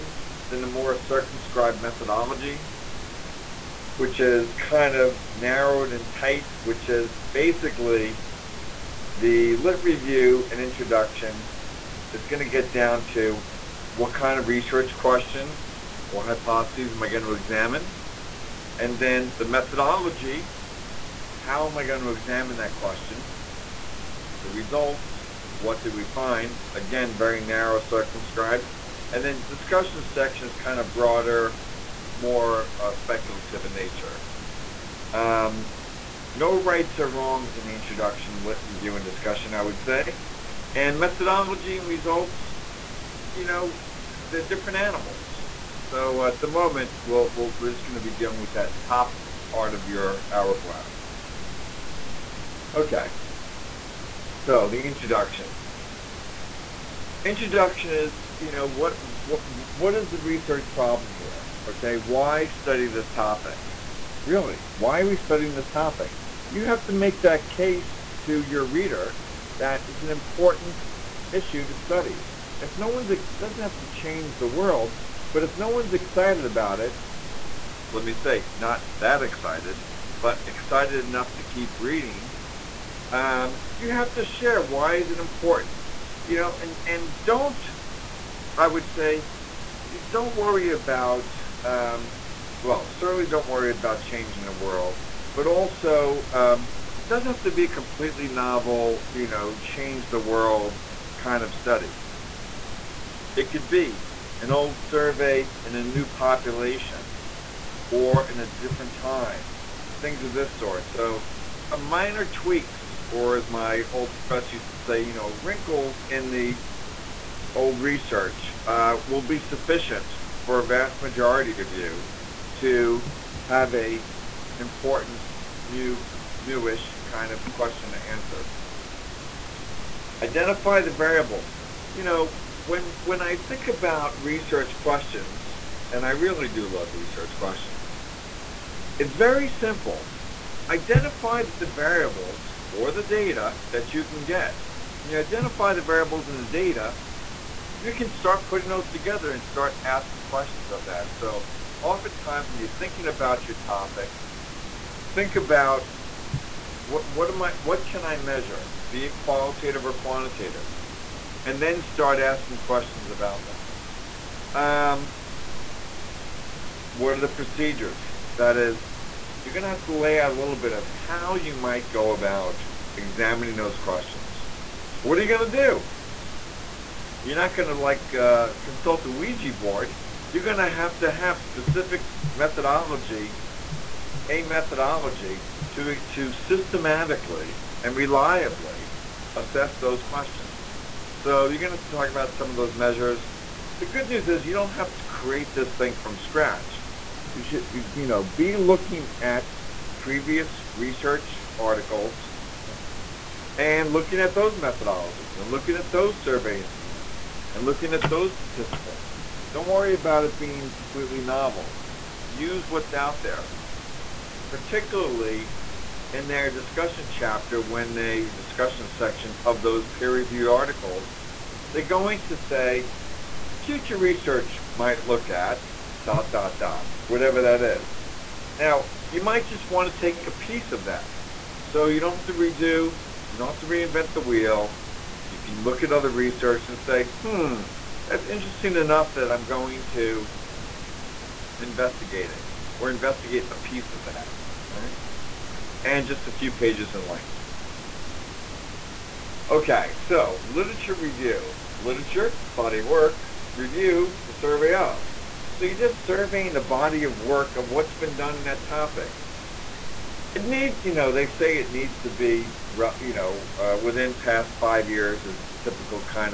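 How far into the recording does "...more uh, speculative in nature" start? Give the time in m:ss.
0:32.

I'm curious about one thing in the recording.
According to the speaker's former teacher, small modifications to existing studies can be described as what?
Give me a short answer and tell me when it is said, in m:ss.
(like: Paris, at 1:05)
Wrinkles, at 1:55.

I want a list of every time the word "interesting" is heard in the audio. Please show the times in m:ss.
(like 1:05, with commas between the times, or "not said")
3:58.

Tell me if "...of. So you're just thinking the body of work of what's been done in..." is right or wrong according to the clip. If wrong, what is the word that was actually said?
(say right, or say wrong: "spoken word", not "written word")
wrong: "surveying", not "thinking".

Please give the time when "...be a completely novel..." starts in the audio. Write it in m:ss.
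1:37.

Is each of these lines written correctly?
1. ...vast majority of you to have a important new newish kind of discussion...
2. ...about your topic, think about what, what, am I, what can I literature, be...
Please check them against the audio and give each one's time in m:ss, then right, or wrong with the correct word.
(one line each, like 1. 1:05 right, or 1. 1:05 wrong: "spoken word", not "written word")
1. 2:00 wrong: "question", not "discussion"
2. 2:33 wrong: "measure", not "literature".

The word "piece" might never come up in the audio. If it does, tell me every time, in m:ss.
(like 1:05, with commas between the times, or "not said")
3:50, 4:03.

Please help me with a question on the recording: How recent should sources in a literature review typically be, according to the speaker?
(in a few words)
Within past 5 years.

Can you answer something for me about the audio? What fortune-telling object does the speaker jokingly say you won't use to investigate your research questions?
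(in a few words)
Ouija board.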